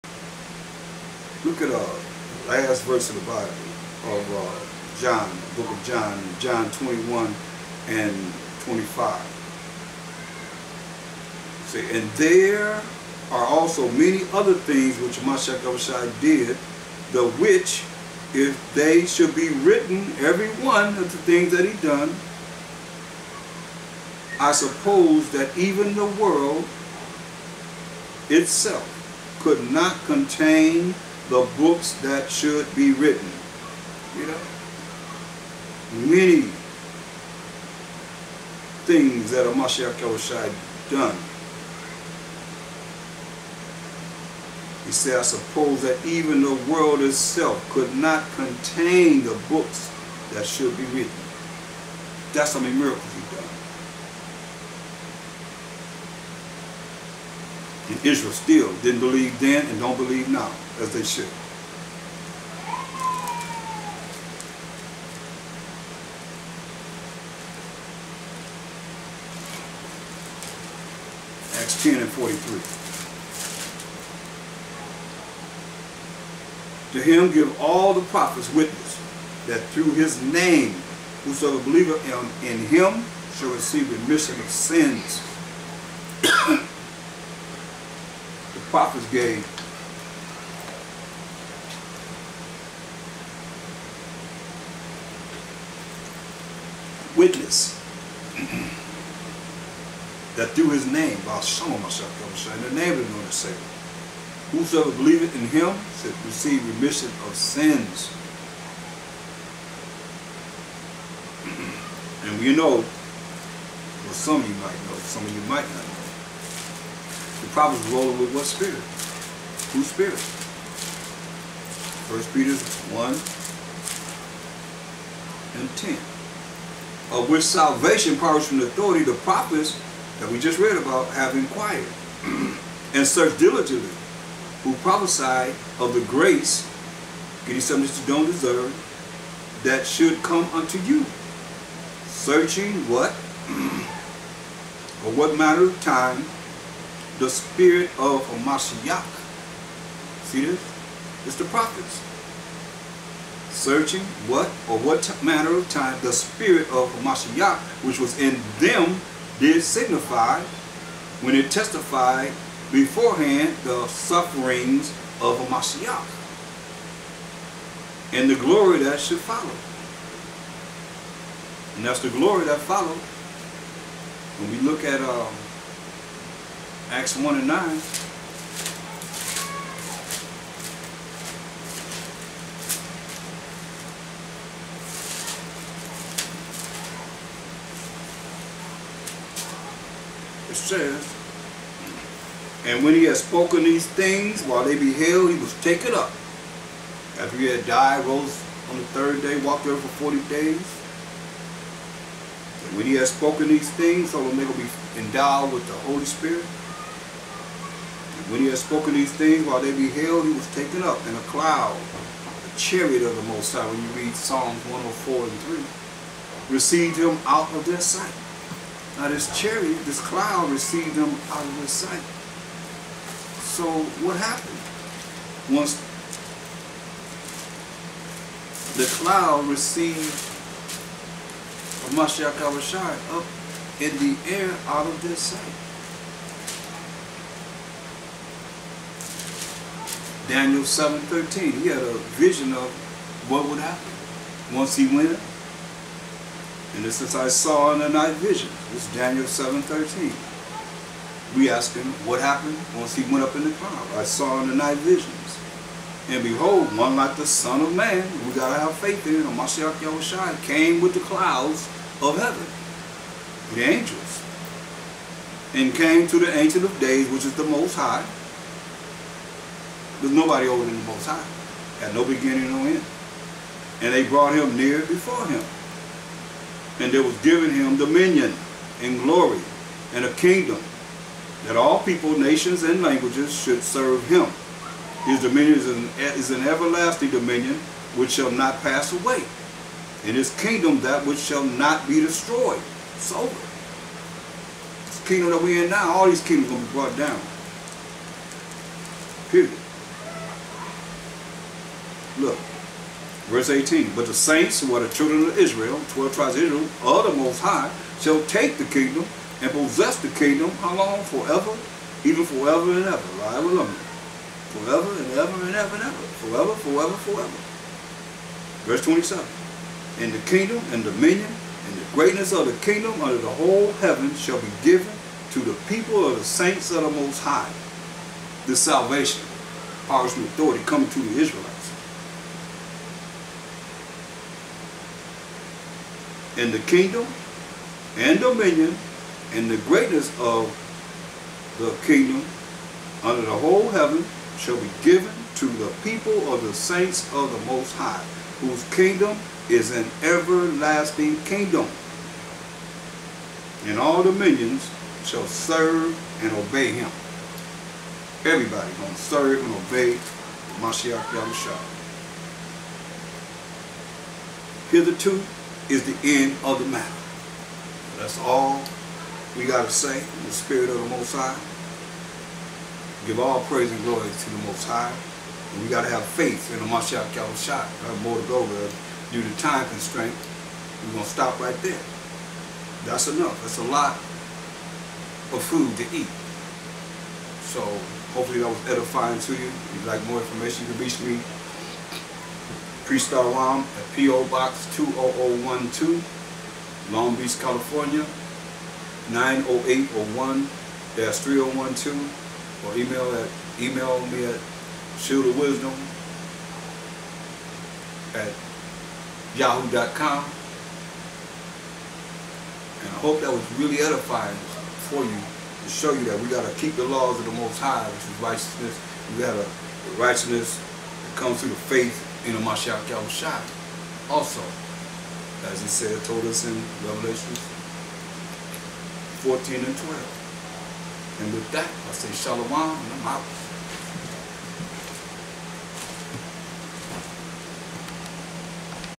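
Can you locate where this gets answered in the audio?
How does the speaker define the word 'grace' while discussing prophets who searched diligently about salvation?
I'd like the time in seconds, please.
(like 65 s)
137 s.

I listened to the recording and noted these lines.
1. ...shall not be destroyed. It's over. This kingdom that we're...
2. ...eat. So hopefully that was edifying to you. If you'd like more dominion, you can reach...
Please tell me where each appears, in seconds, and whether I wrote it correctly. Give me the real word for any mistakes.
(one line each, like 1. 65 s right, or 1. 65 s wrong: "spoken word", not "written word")
1. 291 s right
2. 385 s wrong: "information", not "dominion".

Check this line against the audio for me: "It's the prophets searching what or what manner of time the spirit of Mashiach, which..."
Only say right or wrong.
right.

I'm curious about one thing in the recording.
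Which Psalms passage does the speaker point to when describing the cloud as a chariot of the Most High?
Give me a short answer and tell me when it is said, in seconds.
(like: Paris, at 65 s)
Psalms 104:3, at 214 s.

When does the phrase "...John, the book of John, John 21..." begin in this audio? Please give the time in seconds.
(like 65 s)
5 s.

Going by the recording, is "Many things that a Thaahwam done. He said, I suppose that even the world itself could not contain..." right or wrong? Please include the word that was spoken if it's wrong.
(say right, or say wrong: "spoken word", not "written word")
wrong: "Mashiach", not "Thaahwam".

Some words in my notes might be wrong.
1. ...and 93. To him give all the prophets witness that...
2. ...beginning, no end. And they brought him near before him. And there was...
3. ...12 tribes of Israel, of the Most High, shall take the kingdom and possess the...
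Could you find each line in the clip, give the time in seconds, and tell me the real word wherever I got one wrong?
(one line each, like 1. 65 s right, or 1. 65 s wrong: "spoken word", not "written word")
1. 72 s wrong: "43", not "93"
2. 272 s right
3. 305 s right.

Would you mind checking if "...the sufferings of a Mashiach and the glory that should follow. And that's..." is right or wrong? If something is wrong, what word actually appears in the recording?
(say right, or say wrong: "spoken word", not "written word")
right.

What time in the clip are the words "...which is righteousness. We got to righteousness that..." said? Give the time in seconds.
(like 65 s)
417 s.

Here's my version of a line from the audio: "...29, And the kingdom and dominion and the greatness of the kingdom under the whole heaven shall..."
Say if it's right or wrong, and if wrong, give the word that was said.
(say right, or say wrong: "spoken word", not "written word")
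wrong: "27", not "29".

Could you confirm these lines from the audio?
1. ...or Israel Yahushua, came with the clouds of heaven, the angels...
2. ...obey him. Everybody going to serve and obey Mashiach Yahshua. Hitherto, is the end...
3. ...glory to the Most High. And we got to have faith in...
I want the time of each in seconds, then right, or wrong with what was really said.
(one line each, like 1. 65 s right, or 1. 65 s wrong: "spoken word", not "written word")
1. 259 s wrong: "Mashiach", not "Israel"
2. 356 s right
3. 373 s right.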